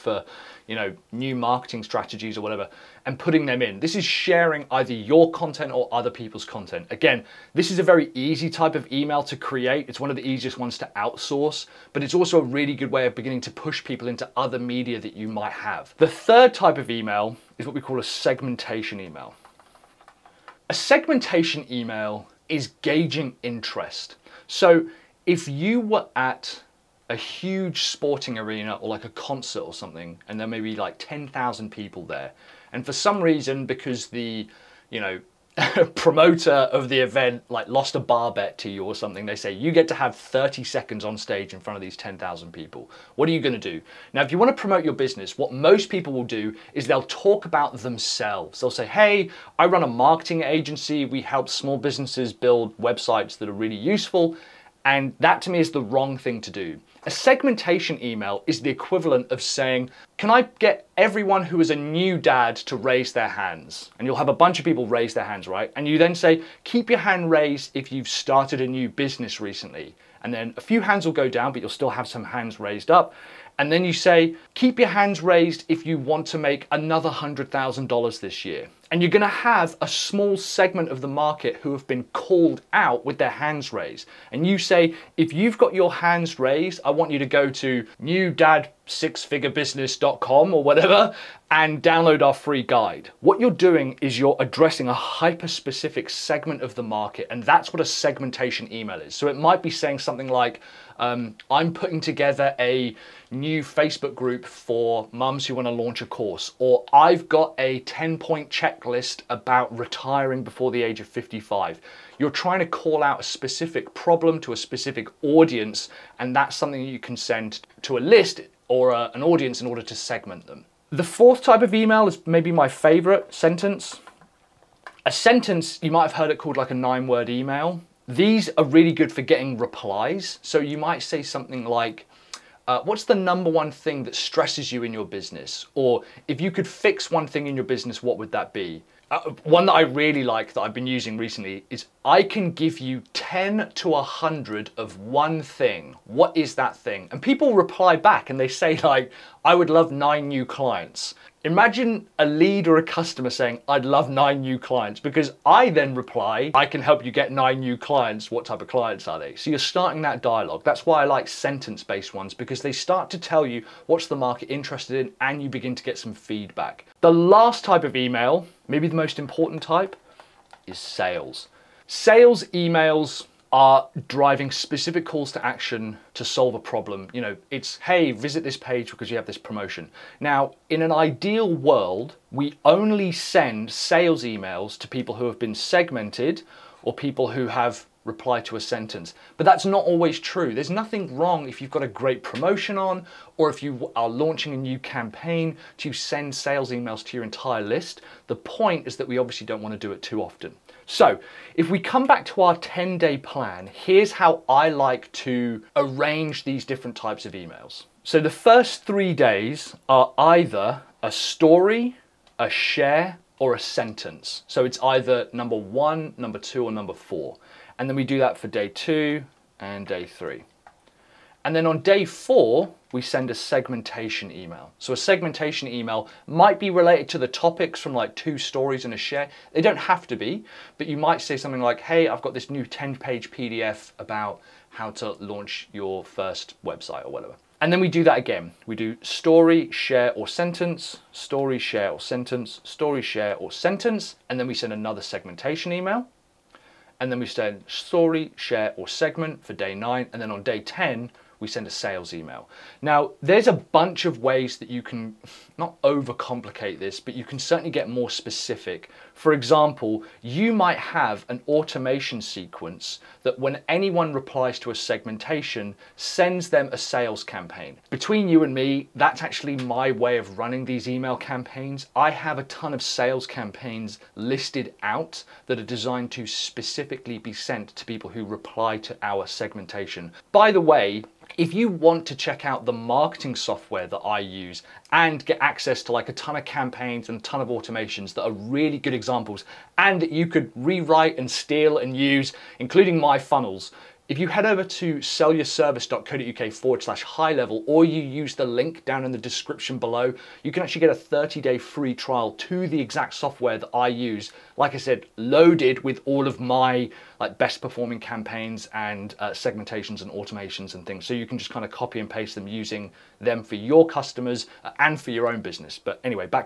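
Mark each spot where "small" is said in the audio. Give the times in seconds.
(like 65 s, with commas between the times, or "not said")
51 s, 79 s.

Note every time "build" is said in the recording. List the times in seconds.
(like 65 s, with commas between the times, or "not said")
52 s.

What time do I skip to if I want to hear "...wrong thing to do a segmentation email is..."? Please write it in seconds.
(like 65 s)
55 s.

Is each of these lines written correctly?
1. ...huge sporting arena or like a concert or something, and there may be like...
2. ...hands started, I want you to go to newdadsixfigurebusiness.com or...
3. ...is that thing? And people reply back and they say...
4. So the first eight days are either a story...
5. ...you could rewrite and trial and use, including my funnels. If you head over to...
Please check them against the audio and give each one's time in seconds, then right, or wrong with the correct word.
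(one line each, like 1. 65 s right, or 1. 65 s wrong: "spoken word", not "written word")
1. 27 s right
2. 85 s wrong: "raised", not "started"
3. 146 s right
4. 208 s wrong: "three", not "eight"
5. 290 s wrong: "steal", not "trial".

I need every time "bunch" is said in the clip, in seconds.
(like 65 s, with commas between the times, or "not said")
64 s, 253 s.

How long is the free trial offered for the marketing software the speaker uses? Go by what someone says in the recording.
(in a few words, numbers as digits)
30 day.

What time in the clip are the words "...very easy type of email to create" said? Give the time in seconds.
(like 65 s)
7 s.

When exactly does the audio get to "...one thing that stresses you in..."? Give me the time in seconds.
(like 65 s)
133 s.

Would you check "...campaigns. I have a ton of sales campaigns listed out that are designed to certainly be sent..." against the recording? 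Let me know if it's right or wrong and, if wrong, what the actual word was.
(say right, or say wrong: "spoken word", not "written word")
wrong: "specifically", not "certainly".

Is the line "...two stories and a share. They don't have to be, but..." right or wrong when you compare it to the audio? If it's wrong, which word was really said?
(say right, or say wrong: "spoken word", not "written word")
right.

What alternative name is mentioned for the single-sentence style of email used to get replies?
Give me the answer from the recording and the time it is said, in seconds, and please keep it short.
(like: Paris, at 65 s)
nine word email, at 126 s.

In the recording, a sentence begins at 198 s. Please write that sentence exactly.
The point is that we obviously don't want to do it too often.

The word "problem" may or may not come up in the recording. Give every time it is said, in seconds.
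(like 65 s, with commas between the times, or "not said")
113 s, 176 s.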